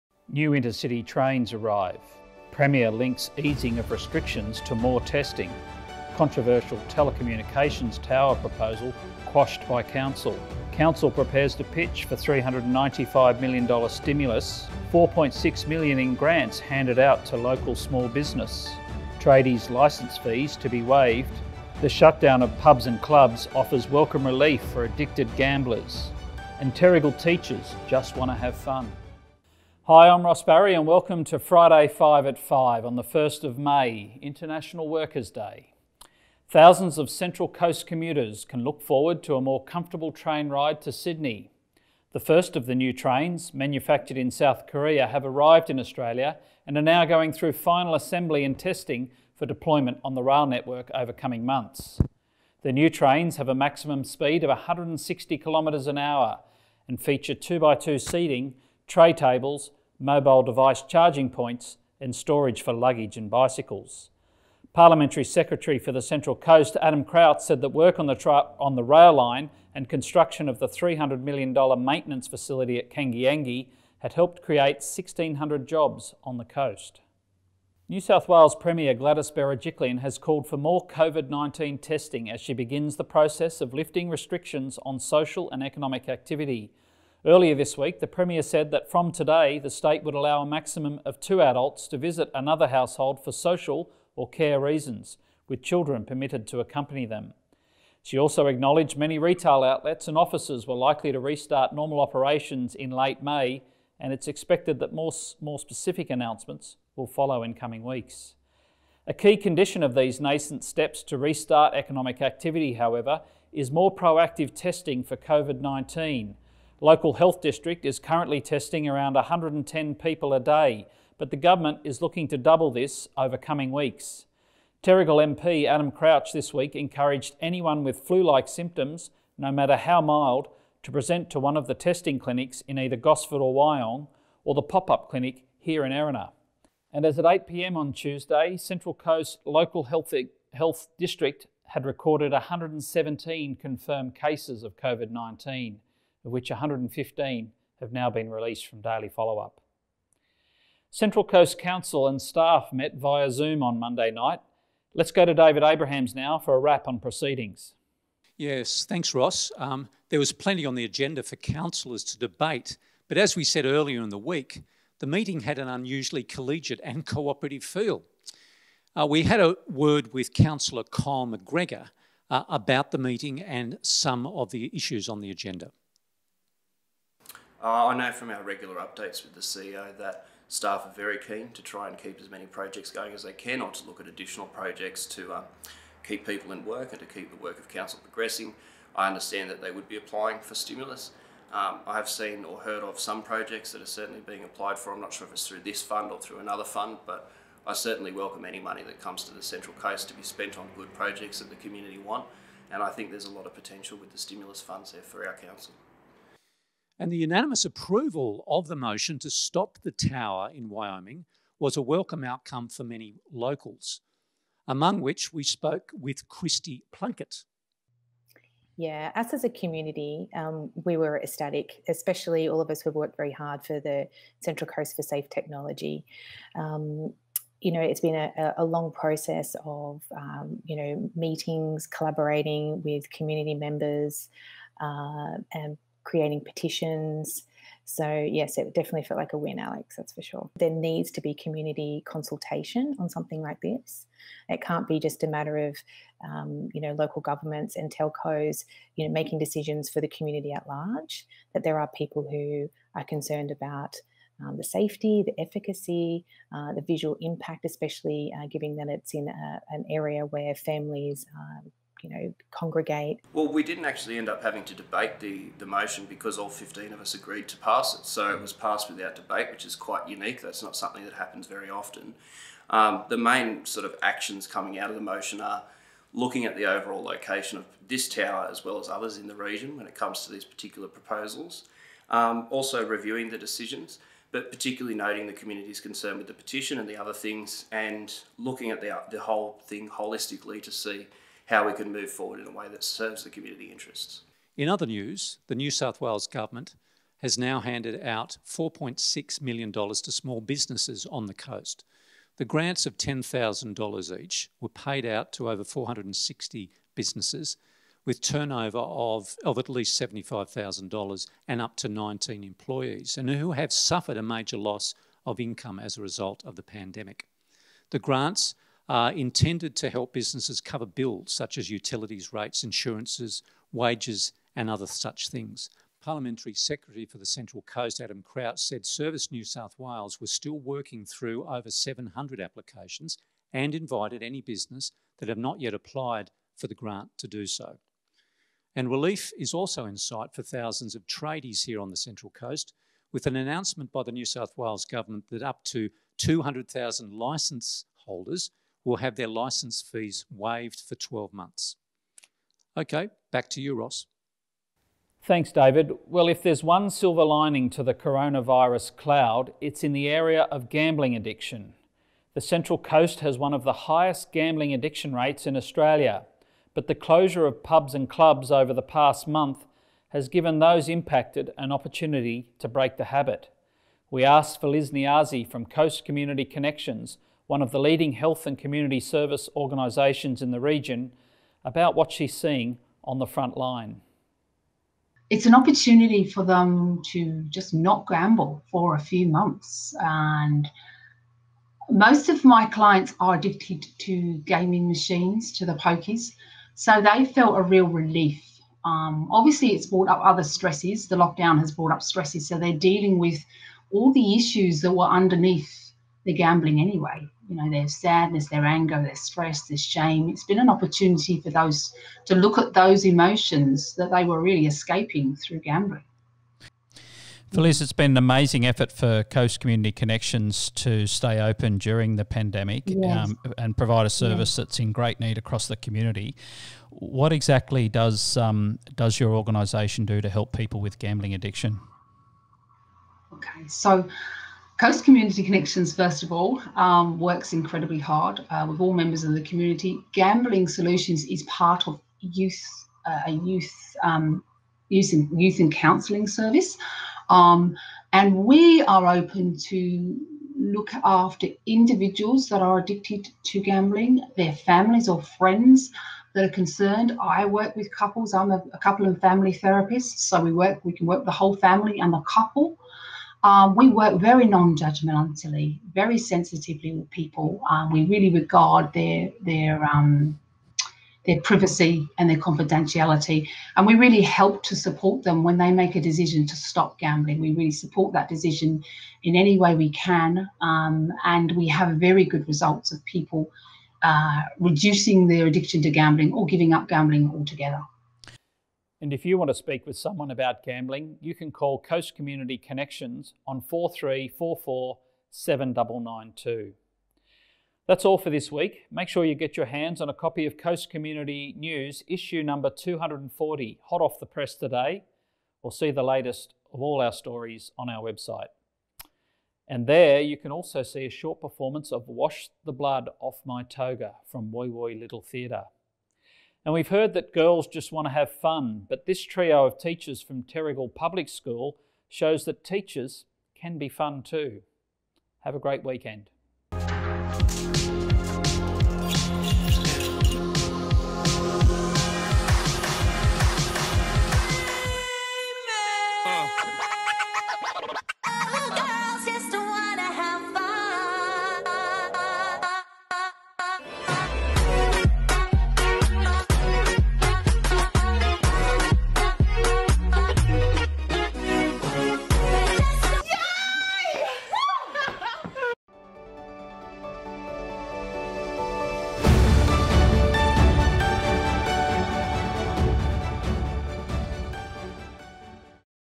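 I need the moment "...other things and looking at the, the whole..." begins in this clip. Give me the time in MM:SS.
04:46.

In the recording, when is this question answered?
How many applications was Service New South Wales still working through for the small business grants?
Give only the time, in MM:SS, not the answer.
05:31.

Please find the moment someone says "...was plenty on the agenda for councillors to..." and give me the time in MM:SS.
02:40.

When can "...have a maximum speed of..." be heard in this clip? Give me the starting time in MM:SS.
00:53.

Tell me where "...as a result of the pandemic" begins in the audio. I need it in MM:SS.
05:15.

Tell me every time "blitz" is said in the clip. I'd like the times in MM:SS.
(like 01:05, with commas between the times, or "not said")
not said.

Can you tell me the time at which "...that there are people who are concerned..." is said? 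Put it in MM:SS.
04:11.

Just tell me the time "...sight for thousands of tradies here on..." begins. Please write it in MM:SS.
05:39.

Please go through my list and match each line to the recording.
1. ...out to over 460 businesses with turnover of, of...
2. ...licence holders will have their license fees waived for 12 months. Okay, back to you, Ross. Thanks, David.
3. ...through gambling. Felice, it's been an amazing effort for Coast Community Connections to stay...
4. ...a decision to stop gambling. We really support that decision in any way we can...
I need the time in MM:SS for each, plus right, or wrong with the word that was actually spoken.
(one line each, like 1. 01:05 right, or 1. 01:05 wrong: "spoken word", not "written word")
1. 05:05 right
2. 05:47 right
3. 06:55 right
4. 07:55 right.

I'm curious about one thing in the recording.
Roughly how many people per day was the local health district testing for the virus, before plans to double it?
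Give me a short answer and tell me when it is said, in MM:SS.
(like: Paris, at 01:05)
110, at 01:59.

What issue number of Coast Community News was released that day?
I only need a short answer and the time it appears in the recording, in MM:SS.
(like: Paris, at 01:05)
240, at 08:22.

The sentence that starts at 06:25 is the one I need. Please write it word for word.
It's an opportunity for them to just not gamble for a few months.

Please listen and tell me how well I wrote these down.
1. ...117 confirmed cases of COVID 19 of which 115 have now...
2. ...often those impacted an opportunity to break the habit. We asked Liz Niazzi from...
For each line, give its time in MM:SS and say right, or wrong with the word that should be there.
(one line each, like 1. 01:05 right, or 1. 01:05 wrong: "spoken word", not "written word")
1. 02:22 right
2. 06:10 wrong: "given", not "often".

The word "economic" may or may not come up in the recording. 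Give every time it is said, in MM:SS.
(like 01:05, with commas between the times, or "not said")
01:25, 01:51.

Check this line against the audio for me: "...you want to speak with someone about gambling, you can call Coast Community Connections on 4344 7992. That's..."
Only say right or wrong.
right.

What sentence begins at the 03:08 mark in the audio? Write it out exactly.
I understand that they would be applying for stimulus.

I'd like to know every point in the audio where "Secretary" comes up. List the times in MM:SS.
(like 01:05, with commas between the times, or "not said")
01:05, 05:26.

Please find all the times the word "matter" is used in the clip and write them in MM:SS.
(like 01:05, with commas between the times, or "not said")
02:09, 04:05.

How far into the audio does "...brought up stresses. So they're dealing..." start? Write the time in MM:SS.
06:41.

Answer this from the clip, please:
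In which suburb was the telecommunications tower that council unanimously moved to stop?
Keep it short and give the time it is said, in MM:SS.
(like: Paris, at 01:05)
Wyoming, at 03:30.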